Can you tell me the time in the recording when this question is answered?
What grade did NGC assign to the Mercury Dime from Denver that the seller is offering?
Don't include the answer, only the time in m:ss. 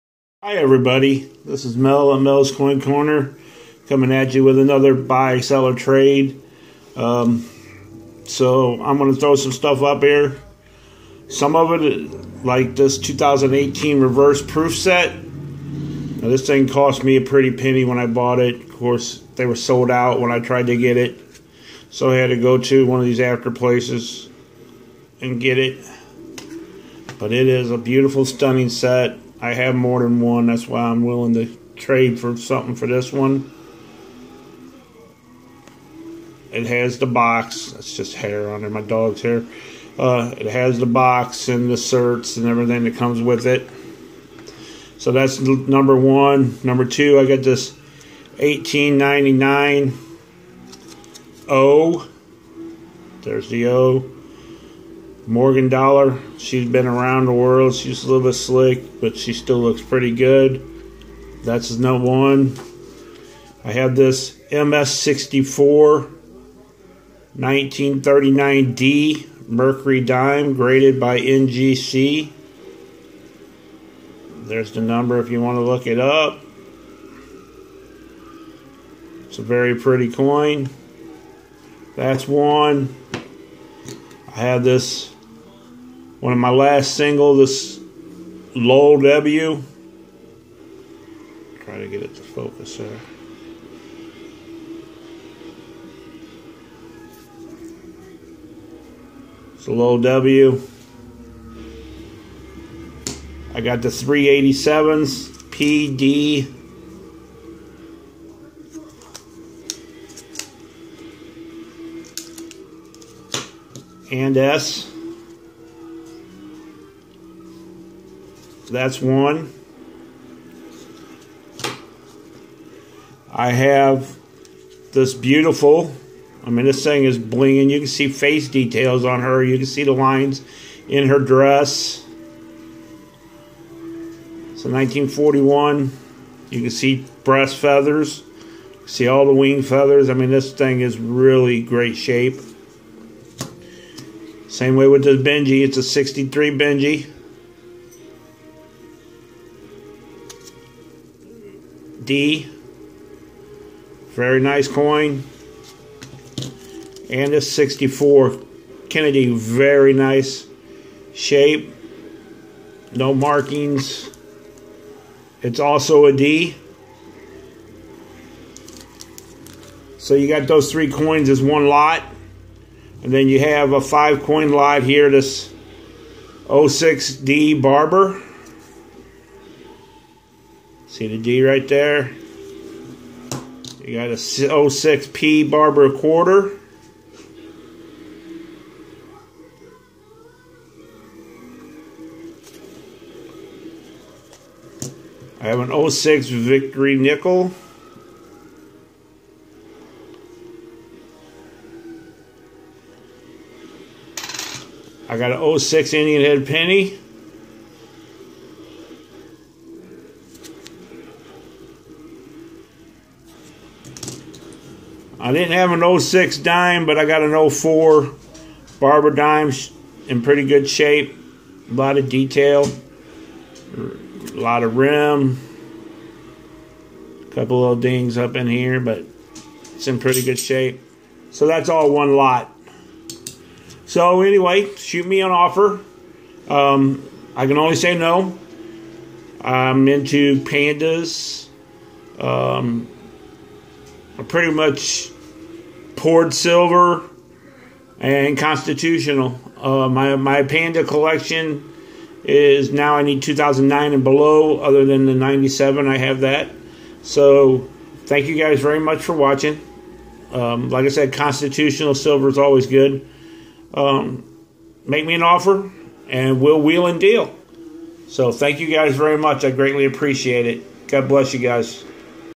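1:04.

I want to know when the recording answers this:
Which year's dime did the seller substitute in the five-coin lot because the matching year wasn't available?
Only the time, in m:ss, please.
3:37.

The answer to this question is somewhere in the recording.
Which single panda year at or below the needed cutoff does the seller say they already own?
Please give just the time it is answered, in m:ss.
4:15.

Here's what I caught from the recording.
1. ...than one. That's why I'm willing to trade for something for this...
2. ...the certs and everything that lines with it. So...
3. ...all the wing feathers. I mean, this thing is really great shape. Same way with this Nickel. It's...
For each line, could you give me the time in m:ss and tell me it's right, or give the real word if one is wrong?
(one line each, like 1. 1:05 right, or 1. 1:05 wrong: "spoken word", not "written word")
1. 0:30 right
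2. 0:41 wrong: "comes", not "lines"
3. 2:19 wrong: "Benji", not "Nickel".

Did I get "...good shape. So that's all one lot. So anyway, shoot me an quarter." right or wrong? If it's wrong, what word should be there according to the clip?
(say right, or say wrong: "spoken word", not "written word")
wrong: "offer", not "quarter".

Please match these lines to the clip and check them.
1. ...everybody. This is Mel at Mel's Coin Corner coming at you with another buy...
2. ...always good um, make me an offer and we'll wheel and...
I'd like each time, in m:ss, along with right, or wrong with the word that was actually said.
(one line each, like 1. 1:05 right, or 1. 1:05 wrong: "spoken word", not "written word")
1. 0:00 right
2. 4:22 right.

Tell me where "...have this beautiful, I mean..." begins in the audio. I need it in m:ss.
2:03.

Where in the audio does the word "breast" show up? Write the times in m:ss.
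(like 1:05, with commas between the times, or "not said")
2:17.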